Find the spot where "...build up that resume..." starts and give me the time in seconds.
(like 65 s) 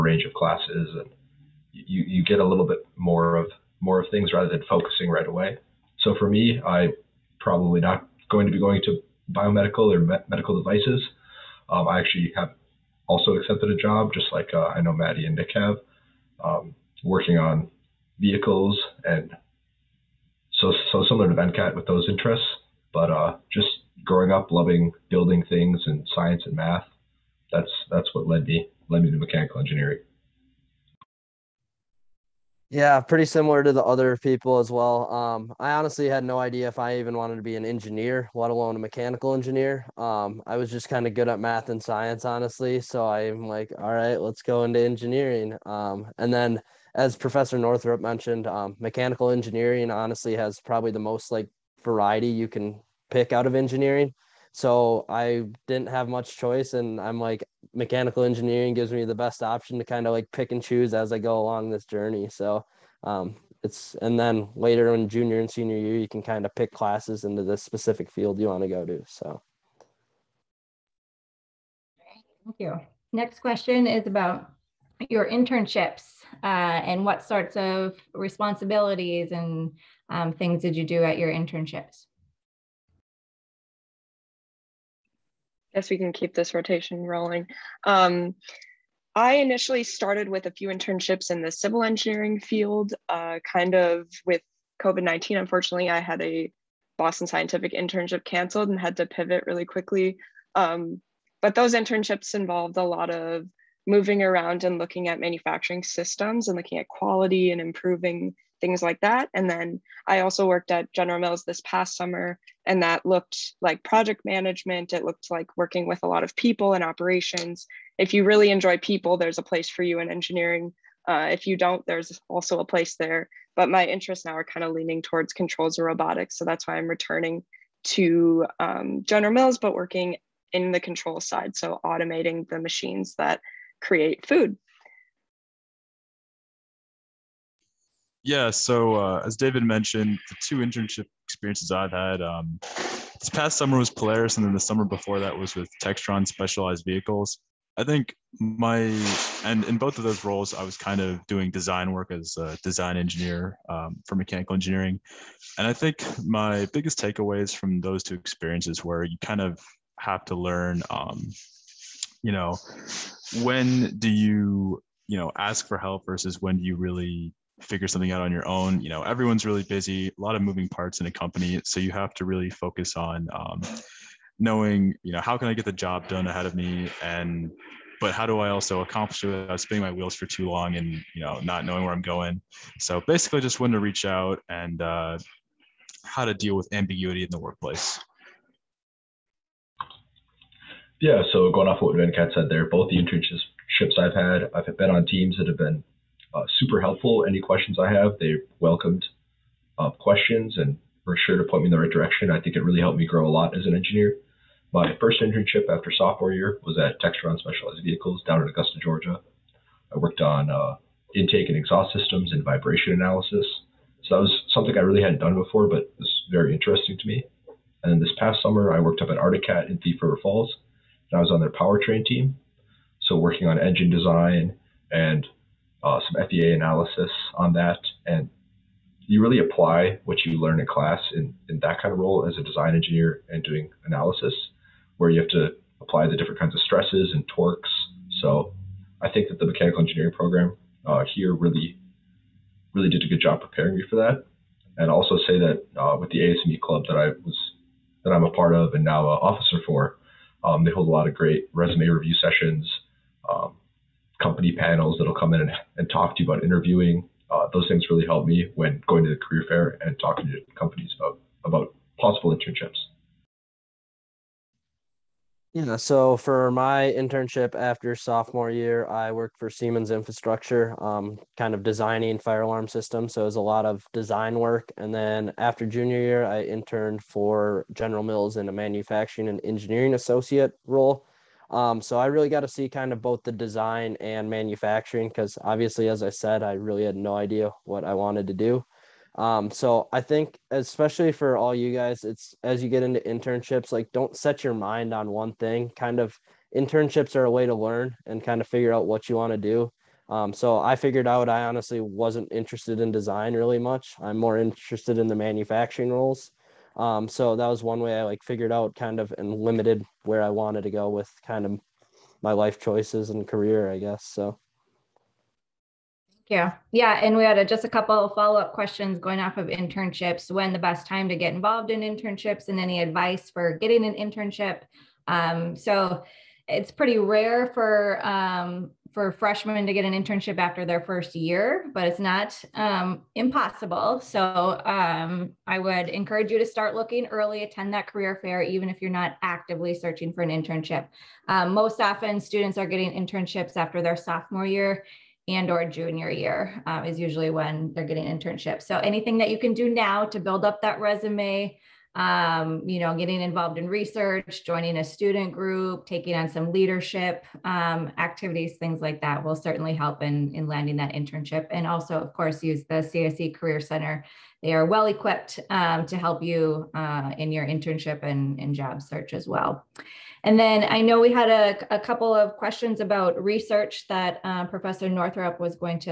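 350 s.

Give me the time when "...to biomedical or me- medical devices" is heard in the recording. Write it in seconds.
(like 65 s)
8 s.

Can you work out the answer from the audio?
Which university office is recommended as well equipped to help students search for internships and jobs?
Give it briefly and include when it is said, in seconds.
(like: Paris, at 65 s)
CSE Career Center, at 362 s.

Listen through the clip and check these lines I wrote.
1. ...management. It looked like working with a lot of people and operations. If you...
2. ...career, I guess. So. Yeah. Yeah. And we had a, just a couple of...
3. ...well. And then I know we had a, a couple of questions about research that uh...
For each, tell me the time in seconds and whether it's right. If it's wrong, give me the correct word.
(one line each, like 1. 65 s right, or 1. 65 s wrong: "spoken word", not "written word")
1. 114 s right
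2. 313 s right
3. 369 s right.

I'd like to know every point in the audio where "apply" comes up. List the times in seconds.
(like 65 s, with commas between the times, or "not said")
229 s, 235 s.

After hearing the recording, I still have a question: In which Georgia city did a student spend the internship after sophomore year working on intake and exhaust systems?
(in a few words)
Augusta.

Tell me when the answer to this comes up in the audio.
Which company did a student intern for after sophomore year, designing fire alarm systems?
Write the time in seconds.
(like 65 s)
269 s.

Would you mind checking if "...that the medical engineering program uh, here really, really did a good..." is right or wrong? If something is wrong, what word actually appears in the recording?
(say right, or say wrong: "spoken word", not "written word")
wrong: "mechanical", not "medical".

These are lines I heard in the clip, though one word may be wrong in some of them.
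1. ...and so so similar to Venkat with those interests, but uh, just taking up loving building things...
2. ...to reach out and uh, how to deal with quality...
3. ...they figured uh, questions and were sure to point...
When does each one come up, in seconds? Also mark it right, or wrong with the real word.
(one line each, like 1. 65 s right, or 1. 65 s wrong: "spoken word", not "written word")
1. 19 s wrong: "growing", not "taking"
2. 183 s wrong: "ambiguity", not "quality"
3. 198 s wrong: "welcomed", not "figured".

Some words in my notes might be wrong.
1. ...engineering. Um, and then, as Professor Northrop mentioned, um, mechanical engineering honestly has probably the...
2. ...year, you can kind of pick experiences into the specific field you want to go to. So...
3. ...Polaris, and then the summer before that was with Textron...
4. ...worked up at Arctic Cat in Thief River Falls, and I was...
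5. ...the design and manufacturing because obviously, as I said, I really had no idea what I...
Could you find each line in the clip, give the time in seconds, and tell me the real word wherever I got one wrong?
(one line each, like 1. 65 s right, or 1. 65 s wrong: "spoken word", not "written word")
1. 44 s right
2. 65 s wrong: "classes", not "experiences"
3. 143 s right
4. 218 s right
5. 283 s right.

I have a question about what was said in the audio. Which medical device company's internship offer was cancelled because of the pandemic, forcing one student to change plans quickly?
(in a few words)
Boston Scientific.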